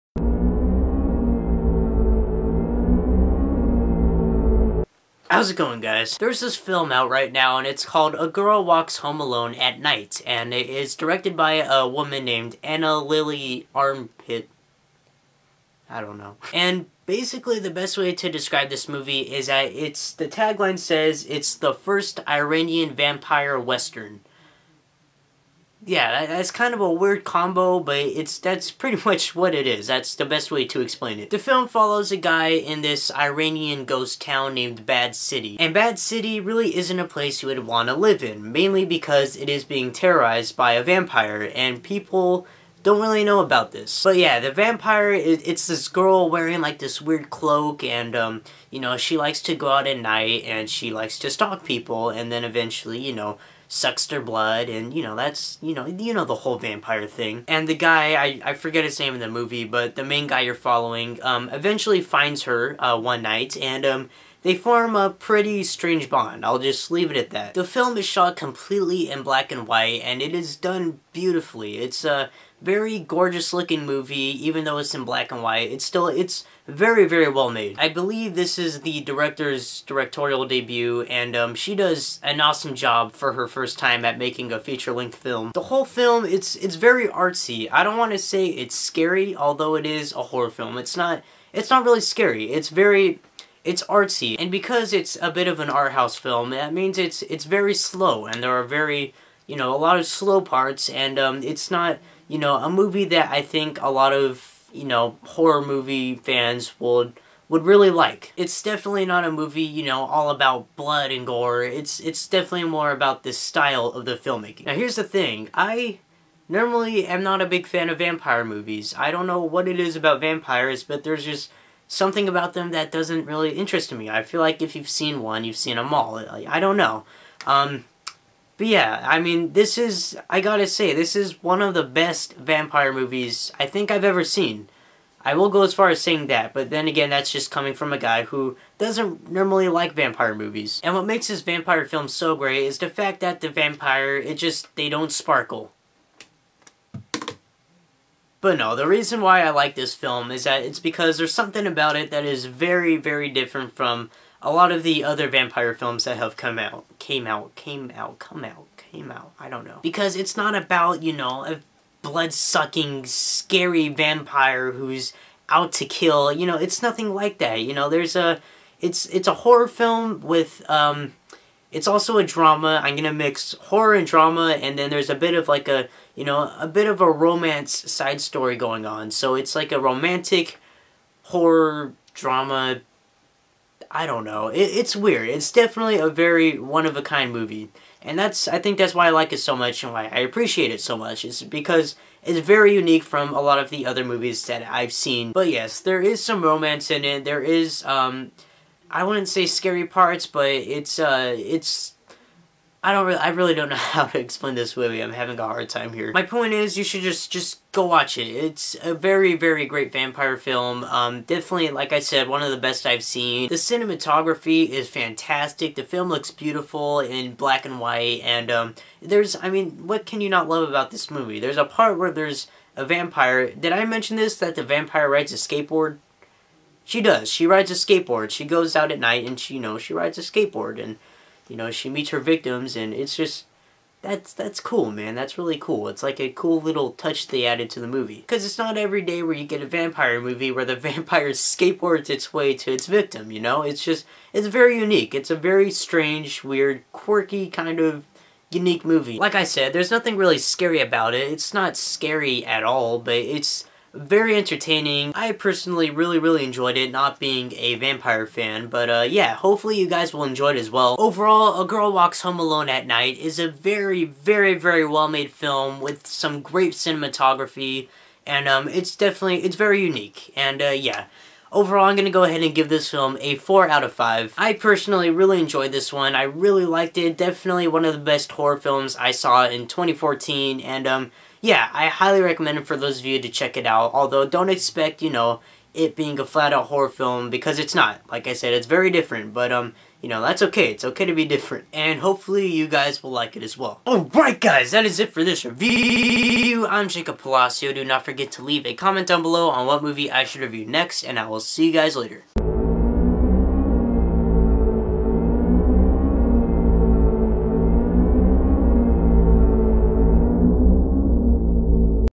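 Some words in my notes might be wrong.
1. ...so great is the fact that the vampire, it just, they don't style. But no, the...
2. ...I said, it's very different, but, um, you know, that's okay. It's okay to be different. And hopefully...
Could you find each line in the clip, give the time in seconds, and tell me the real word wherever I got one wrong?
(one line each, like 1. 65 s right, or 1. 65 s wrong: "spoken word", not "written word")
1. 142 s wrong: "sparkle", not "style"
2. 288 s right.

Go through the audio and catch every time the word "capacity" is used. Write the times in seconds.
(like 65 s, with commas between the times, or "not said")
not said.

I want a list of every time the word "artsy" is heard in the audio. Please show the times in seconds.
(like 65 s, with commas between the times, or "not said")
87 s, 93 s.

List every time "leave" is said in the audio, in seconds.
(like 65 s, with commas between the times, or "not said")
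66 s, 298 s.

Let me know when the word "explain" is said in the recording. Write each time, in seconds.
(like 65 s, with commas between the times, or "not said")
30 s, 204 s.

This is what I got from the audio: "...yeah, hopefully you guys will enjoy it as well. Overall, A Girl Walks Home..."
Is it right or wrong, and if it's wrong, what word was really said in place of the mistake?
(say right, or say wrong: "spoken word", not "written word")
right.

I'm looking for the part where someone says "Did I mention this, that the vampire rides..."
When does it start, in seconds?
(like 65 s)
223 s.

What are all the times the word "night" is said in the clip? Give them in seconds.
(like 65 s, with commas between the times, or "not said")
9 s, 49 s, 63 s, 228 s, 262 s.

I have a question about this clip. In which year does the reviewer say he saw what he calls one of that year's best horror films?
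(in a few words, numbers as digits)
2014.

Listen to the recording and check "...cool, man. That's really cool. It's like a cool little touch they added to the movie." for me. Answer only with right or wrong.
right.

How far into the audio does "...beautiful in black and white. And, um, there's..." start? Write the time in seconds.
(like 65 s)
216 s.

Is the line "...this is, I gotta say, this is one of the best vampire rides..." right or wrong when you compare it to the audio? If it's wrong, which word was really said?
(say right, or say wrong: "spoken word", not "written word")
wrong: "movies", not "rides".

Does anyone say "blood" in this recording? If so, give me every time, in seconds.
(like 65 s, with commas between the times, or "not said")
54 s, 110 s, 162 s.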